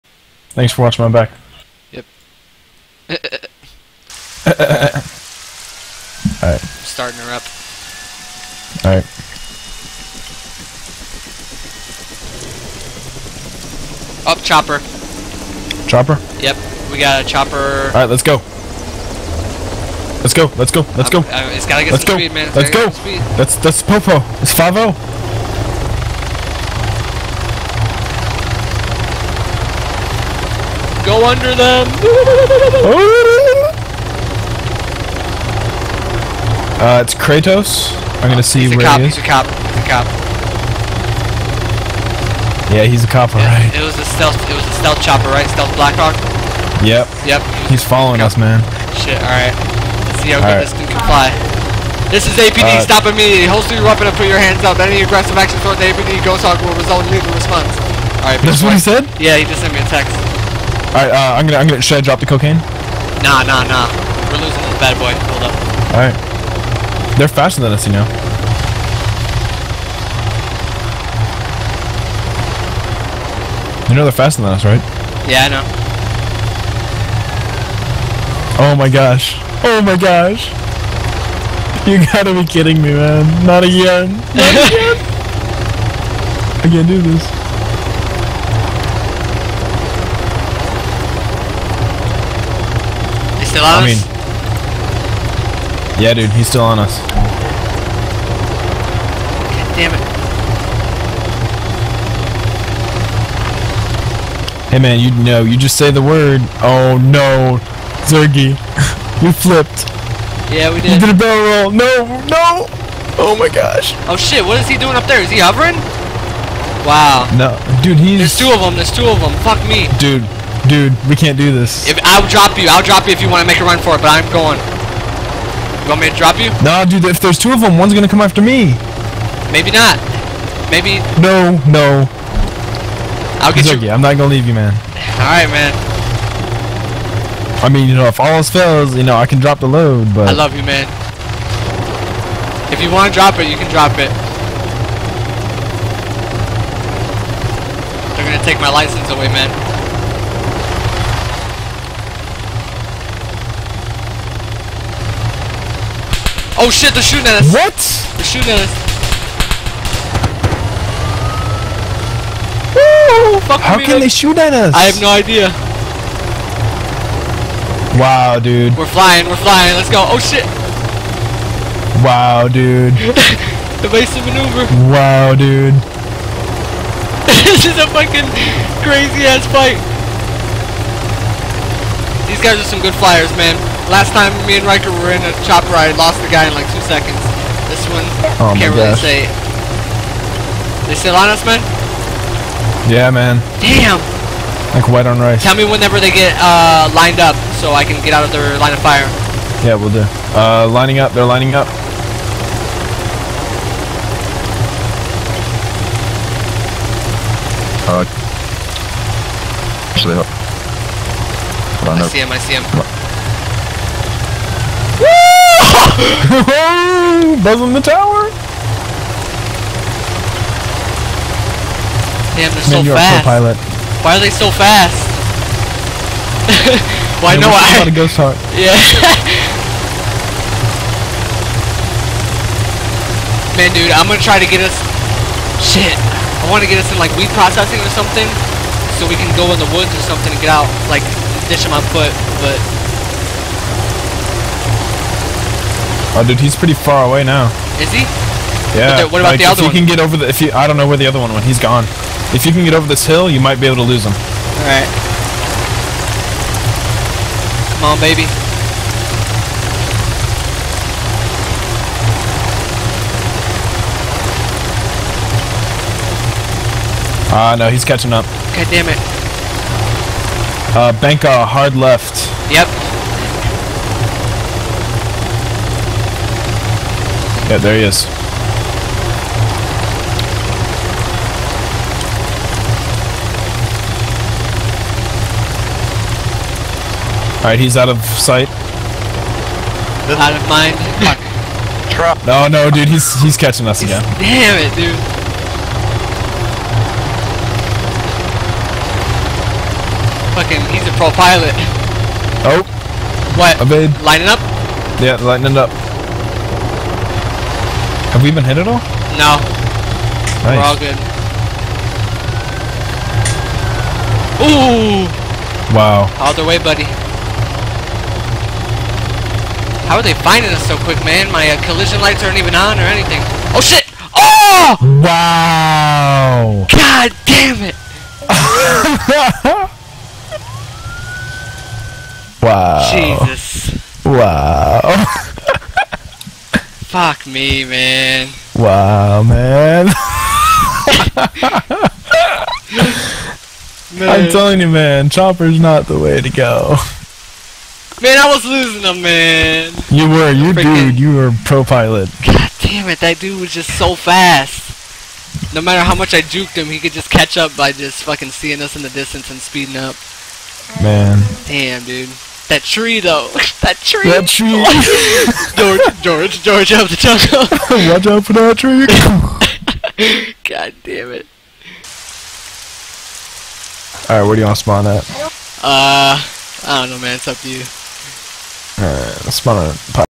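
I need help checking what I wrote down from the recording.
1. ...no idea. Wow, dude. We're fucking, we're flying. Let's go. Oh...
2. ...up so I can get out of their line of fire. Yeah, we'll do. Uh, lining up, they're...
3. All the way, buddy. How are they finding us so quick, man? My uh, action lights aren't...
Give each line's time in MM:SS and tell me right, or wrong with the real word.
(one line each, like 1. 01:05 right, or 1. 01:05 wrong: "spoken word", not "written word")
1. 02:45 wrong: "flying", not "fucking"
2. 03:17 right
3. 05:16 wrong: "collision", not "action".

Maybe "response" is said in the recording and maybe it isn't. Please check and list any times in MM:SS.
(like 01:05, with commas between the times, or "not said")
00:57.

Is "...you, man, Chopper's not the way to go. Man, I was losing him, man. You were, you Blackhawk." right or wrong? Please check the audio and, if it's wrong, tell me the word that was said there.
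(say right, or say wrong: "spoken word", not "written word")
wrong: "Freaking", not "Blackhawk".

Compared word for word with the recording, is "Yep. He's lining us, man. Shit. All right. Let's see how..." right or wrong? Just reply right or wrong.
wrong.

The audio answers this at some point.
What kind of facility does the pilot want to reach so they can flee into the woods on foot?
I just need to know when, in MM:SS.
03:57.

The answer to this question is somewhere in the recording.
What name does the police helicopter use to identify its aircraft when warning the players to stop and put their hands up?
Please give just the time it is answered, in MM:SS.
00:55.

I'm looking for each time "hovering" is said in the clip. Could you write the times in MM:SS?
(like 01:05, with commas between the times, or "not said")
01:55.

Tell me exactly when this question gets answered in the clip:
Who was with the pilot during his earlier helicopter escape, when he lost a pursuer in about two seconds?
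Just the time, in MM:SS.
03:04.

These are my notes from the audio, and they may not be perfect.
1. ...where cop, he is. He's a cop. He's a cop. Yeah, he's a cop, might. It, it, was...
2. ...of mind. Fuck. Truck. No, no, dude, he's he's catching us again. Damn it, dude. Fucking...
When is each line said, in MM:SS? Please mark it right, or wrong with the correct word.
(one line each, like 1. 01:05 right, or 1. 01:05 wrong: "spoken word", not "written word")
1. 00:38 wrong: "alright", not "might"
2. 04:50 right.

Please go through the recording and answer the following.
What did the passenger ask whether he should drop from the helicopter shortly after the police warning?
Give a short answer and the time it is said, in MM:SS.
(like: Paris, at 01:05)
The cocaine, at 01:02.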